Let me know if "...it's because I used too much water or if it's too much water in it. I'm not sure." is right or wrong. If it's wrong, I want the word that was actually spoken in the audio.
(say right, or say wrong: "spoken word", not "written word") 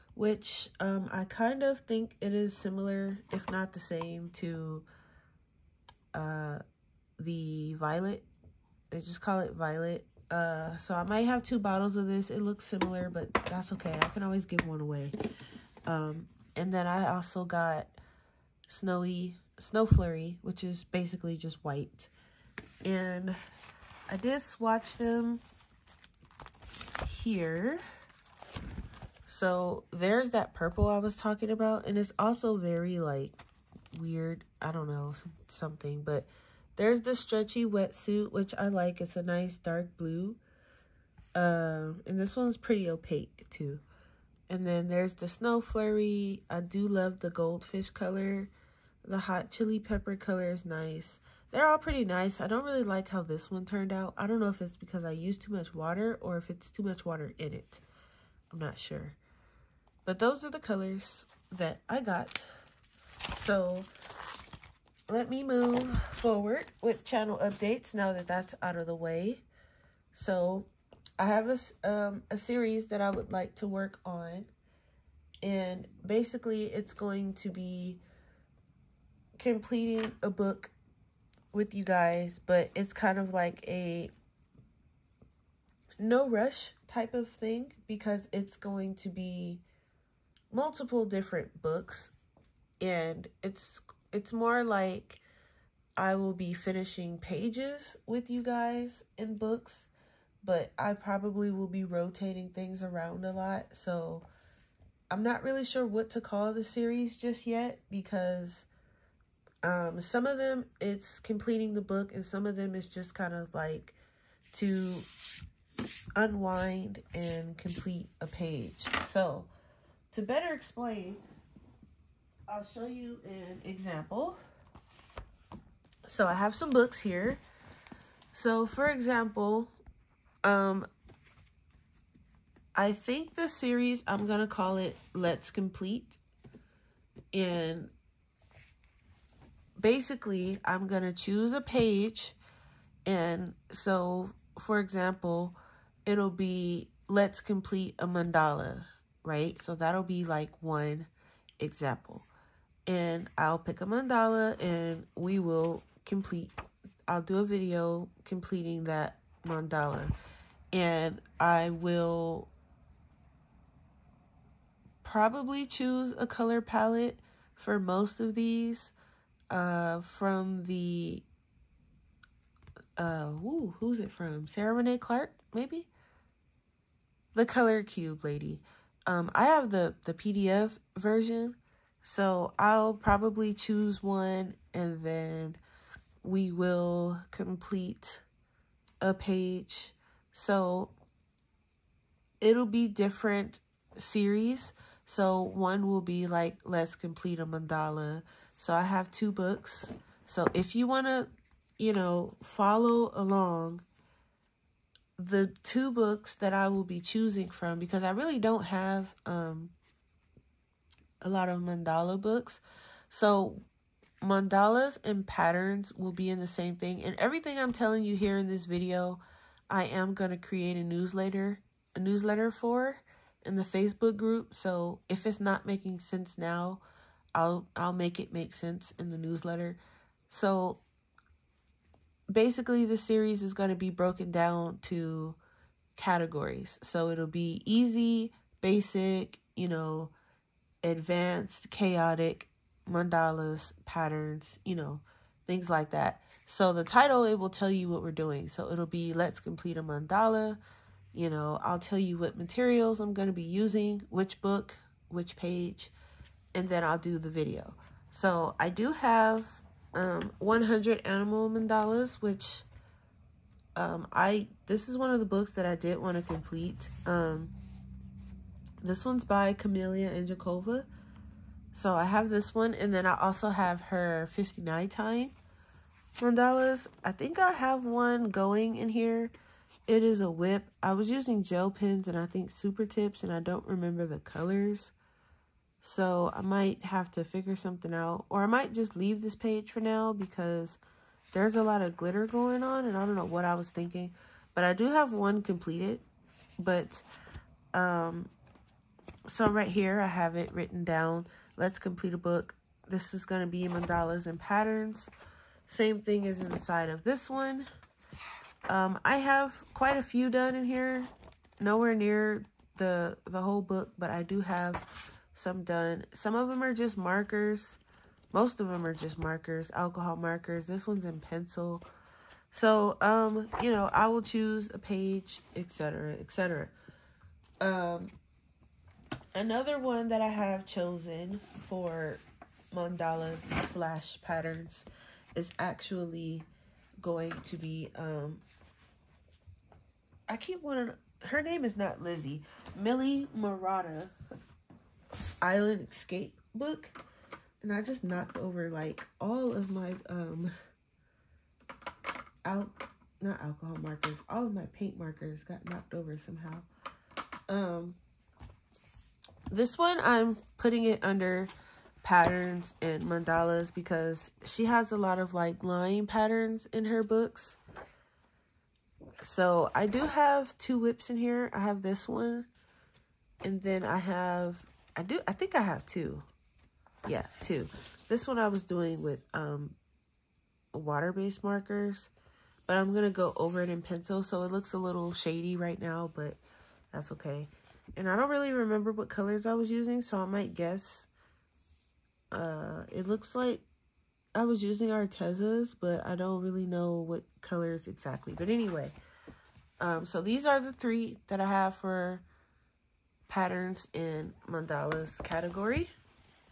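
right.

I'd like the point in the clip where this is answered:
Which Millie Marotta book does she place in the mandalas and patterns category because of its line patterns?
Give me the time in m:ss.
5:45.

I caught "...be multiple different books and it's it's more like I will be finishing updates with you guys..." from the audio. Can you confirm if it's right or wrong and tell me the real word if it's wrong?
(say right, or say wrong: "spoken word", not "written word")
wrong: "pages", not "updates".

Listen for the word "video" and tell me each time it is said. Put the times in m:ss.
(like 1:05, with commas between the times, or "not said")
2:37, 3:38, 4:17.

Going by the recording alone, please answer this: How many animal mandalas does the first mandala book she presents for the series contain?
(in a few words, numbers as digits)
100.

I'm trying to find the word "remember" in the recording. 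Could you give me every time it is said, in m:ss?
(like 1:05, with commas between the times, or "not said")
4:43, 6:28.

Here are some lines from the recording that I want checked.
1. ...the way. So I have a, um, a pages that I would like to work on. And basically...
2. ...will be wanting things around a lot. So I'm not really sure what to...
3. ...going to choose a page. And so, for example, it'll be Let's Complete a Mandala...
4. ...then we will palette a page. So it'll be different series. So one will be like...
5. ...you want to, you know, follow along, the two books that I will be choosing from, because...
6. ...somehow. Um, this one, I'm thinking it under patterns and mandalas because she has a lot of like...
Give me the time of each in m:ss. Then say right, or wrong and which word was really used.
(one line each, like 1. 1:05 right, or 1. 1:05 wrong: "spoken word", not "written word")
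1. 1:08 wrong: "series", not "pages"
2. 1:41 wrong: "rotating", not "wanting"
3. 2:20 right
4. 3:05 wrong: "complete", not "palette"
5. 3:20 right
6. 5:56 wrong: "putting", not "thinking".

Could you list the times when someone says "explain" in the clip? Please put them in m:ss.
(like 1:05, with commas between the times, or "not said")
2:00.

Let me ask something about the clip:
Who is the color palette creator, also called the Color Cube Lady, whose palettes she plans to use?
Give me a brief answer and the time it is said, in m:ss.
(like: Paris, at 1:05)
Sarah Renae Clark, at 2:54.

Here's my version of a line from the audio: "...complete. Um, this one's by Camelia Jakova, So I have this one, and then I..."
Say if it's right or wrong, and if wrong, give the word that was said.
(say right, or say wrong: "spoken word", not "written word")
right.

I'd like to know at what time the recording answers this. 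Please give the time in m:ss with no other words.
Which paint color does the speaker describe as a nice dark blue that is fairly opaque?
0:37.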